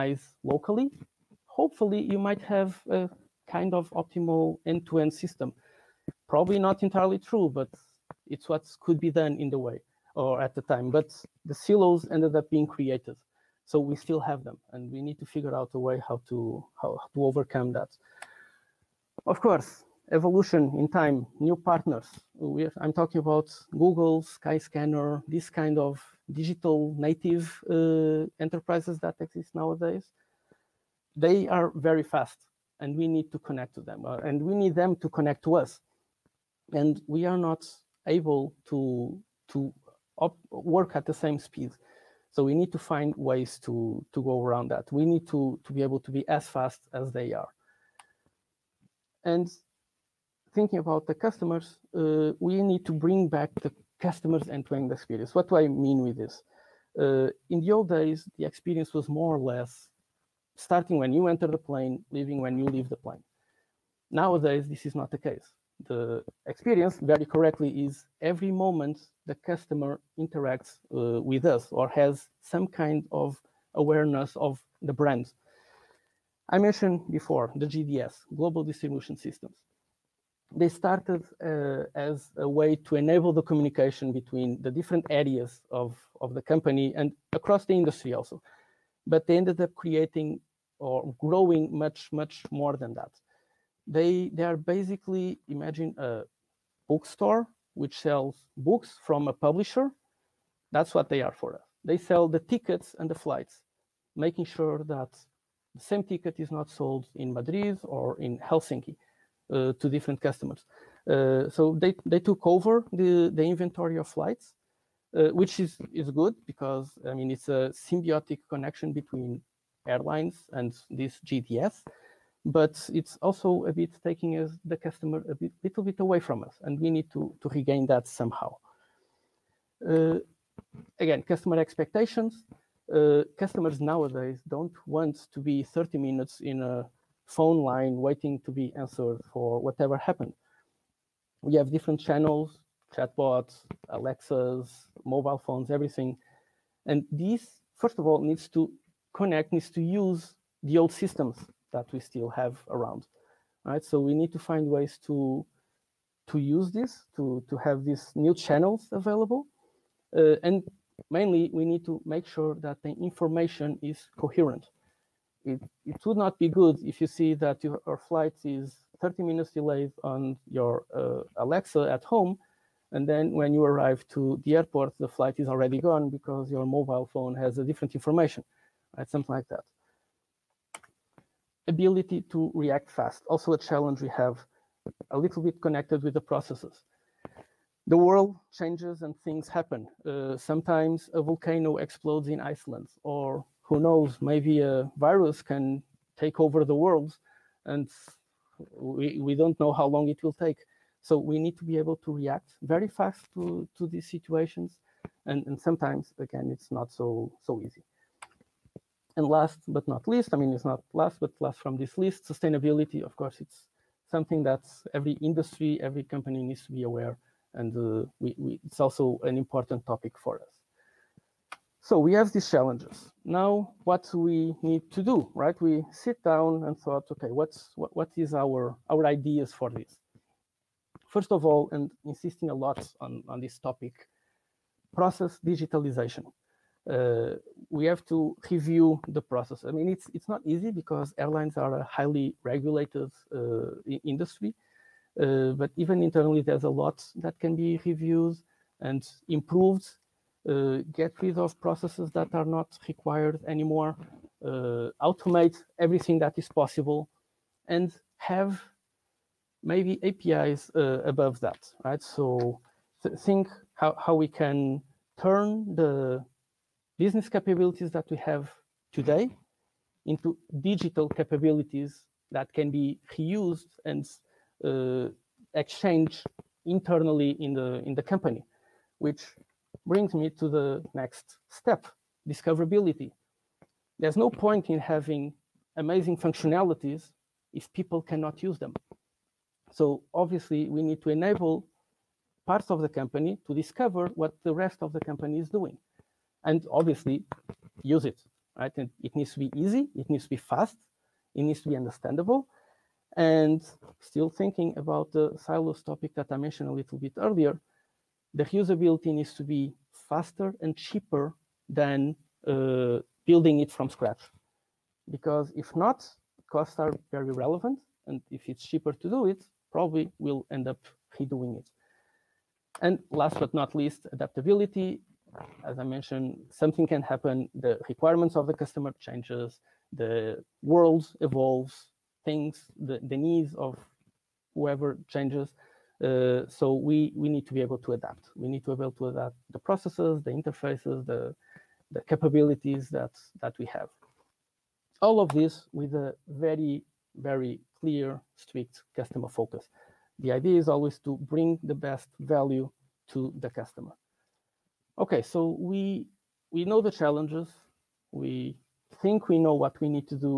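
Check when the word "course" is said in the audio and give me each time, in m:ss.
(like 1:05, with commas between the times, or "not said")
0:19, 3:33.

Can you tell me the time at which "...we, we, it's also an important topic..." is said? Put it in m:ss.
3:38.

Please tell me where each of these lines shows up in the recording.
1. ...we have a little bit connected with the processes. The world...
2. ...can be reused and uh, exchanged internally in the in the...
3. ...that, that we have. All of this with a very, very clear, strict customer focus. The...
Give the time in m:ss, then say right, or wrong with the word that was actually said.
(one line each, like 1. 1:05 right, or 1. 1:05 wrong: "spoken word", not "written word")
1. 3:04 right
2. 4:32 right
3. 5:42 right.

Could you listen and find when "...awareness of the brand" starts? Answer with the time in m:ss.
1:13.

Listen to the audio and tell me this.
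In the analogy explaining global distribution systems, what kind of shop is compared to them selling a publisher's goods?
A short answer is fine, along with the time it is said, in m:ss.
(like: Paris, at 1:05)
A bookstore, at 1:36.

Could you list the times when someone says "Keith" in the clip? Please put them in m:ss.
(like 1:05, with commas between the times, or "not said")
not said.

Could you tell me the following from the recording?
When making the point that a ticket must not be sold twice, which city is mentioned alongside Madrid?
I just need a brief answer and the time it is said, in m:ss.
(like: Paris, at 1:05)
Helsinki, at 1:48.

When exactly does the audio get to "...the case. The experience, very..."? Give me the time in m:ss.
1:05.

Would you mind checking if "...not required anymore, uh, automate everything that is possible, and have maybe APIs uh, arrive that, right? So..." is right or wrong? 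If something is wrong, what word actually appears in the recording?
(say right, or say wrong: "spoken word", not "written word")
wrong: "above", not "arrive".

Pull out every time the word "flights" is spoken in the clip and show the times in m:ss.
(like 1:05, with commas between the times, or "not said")
1:43, 1:54, 2:47, 2:55.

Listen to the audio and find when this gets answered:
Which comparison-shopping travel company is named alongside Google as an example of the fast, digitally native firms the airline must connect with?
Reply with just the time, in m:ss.
0:24.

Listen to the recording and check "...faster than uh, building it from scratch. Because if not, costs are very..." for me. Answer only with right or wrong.
wrong.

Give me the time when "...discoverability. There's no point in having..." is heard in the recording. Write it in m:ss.
4:42.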